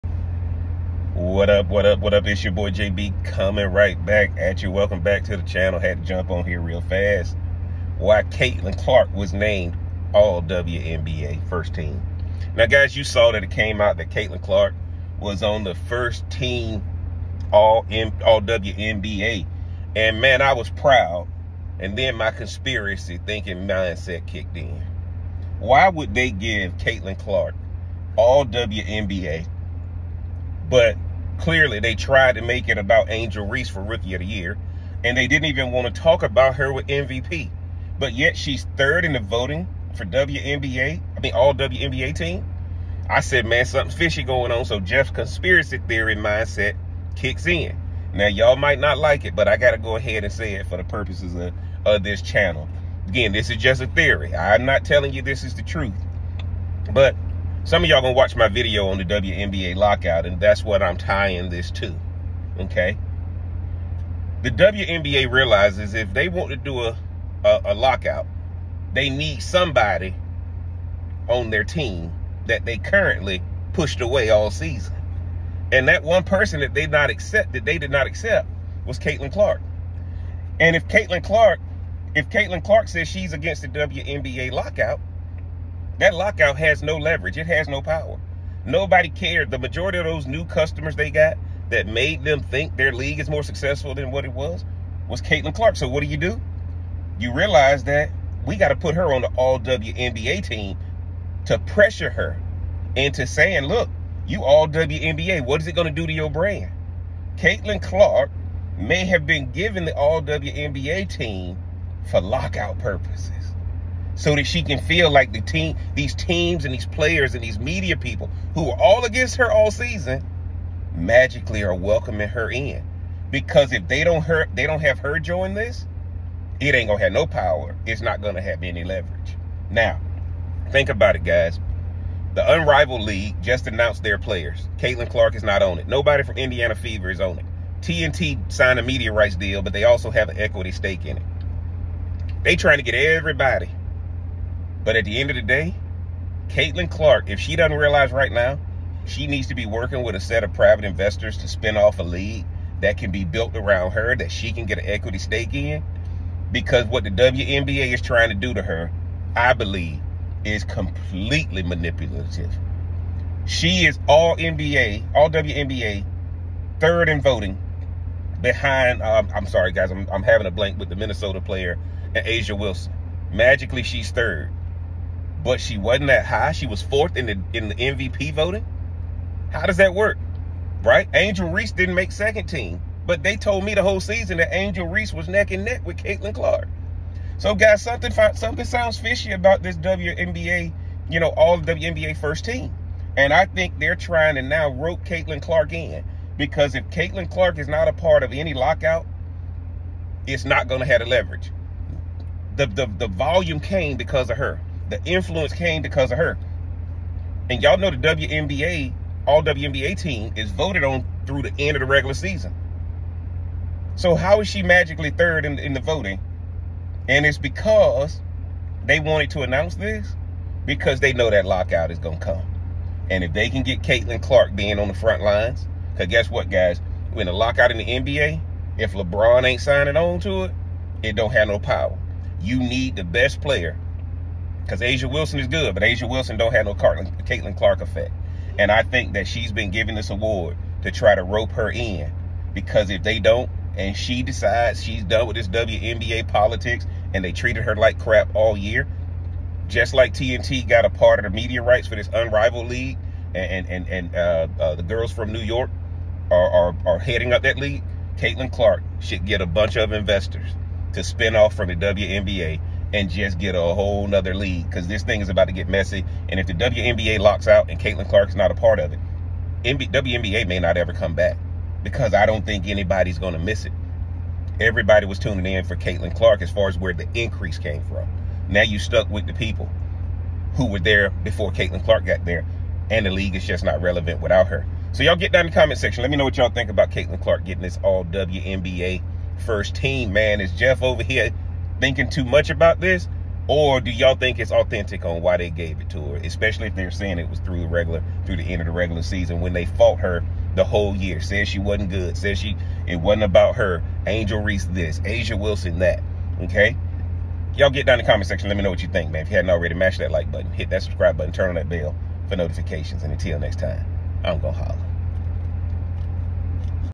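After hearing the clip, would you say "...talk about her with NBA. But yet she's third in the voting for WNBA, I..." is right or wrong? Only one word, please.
wrong.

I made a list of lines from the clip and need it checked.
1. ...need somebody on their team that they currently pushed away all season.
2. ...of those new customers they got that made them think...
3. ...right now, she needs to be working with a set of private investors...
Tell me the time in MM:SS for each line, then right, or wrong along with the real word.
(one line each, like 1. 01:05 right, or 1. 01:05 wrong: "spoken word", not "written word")
1. 01:09 right
2. 01:29 right
3. 02:28 right.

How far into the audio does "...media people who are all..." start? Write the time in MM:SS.
01:57.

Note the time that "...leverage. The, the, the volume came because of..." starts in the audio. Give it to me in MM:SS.
03:21.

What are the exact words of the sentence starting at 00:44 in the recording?
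So Jeff's conspiracy theory mindset kicks in.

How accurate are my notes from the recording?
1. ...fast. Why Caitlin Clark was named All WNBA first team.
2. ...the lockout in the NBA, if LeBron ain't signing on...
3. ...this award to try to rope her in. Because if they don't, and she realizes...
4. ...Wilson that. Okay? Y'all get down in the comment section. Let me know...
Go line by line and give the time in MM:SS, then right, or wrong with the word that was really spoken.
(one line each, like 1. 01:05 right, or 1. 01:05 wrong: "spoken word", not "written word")
1. 00:06 right
2. 03:47 right
3. 03:59 wrong: "decides", not "realizes"
4. 05:05 right.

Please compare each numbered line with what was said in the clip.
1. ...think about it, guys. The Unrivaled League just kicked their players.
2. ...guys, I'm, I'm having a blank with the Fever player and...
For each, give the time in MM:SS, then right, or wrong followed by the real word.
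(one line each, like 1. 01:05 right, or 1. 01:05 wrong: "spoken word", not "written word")
1. 02:10 wrong: "announced", not "kicked"
2. 02:49 wrong: "Minnesota", not "Fever".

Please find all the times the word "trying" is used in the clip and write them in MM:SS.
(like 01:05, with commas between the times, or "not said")
02:22, 02:38, 03:13.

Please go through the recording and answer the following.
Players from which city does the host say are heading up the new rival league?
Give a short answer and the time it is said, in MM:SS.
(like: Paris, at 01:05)
New York, at 04:15.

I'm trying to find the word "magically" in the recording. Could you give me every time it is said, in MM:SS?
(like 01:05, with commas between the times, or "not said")
02:00, 02:53, 03:34.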